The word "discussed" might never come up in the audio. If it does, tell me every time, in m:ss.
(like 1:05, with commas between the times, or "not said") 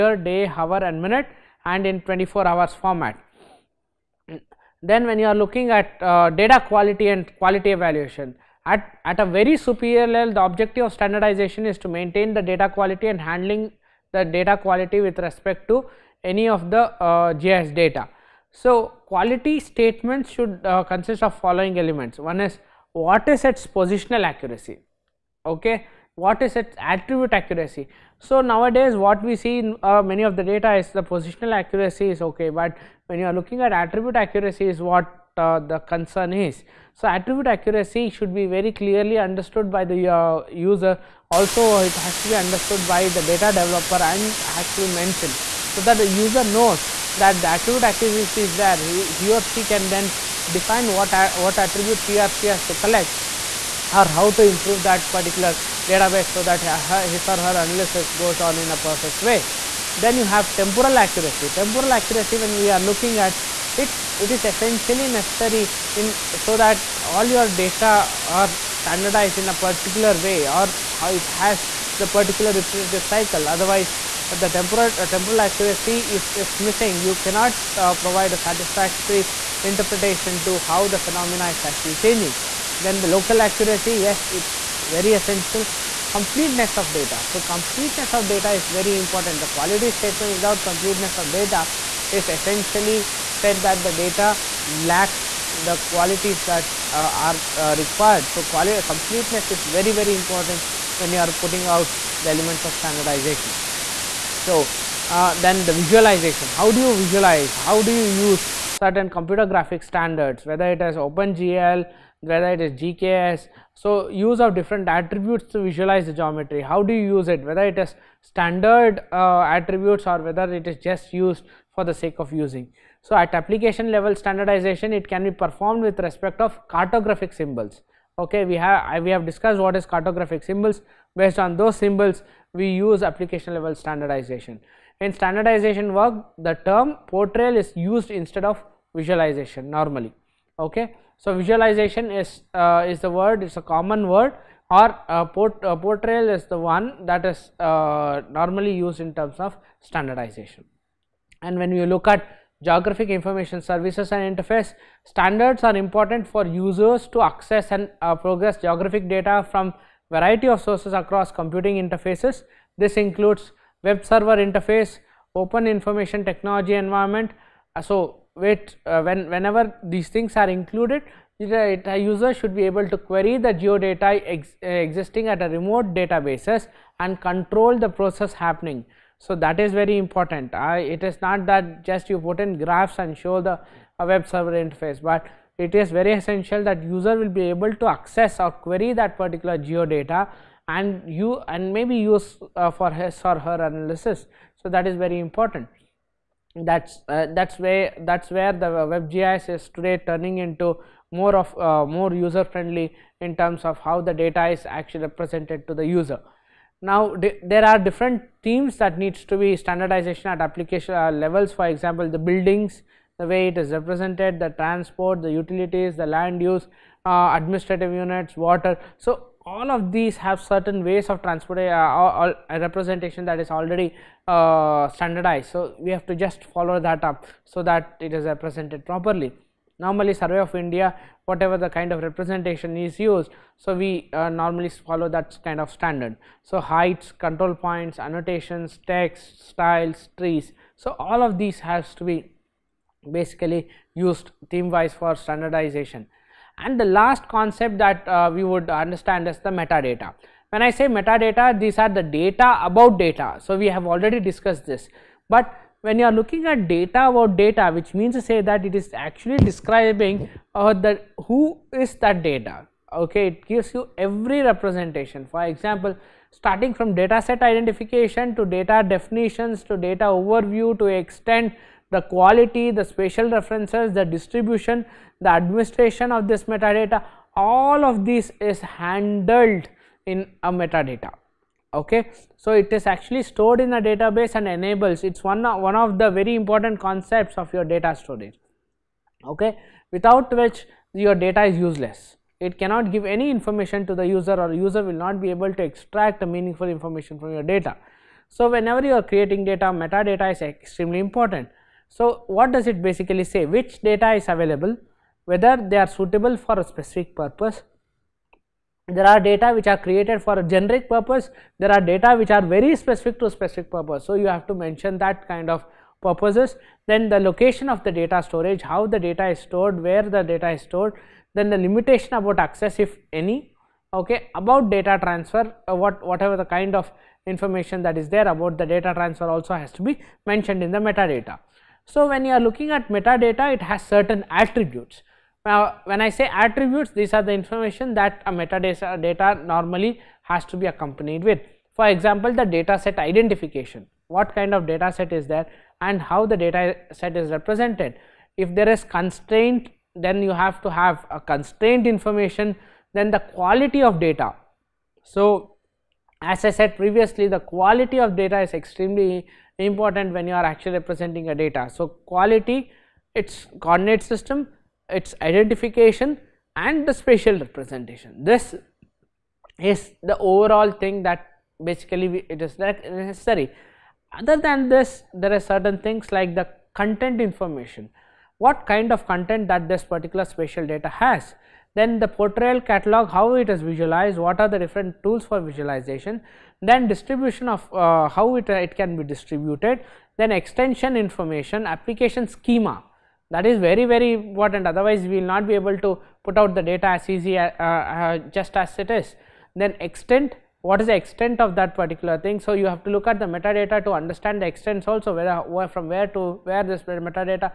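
2:09, 4:14.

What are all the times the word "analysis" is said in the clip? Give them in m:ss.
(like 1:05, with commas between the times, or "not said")
0:57, 3:13.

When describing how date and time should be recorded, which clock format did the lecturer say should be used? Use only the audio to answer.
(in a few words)
24 hours format.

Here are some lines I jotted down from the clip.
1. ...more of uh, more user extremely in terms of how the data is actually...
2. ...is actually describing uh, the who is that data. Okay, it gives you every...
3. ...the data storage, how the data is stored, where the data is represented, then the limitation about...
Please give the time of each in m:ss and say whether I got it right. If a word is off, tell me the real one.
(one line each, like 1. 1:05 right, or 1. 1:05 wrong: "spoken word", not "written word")
1. 3:21 wrong: "friendly", not "extremely"
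2. 4:18 right
3. 5:17 wrong: "stored", not "represented".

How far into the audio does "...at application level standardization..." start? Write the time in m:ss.
2:03.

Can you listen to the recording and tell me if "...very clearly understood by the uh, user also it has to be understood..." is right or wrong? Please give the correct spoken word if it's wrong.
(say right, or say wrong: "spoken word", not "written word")
right.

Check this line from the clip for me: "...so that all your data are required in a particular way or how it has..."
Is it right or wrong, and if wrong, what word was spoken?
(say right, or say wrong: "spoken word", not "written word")
wrong: "standardized", not "required".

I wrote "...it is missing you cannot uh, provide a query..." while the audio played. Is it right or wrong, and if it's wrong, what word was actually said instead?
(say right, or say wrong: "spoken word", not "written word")
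wrong: "satisfactory", not "query".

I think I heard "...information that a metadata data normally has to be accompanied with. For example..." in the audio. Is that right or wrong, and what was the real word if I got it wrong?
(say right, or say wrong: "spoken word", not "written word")
right.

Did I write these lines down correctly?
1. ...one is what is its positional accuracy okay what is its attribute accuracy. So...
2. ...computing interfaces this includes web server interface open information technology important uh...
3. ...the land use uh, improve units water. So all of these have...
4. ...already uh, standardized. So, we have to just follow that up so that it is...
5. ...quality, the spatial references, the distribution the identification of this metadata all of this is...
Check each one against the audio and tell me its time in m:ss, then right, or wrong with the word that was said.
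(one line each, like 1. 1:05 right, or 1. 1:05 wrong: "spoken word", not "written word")
1. 0:22 right
2. 2:41 wrong: "environment", not "important"
3. 3:35 wrong: "administrative", not "improve"
4. 3:43 right
5. 4:32 wrong: "administration", not "identification".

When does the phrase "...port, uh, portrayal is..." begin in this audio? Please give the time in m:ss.
2:25.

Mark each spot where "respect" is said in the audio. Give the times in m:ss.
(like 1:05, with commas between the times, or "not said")
0:15, 2:05.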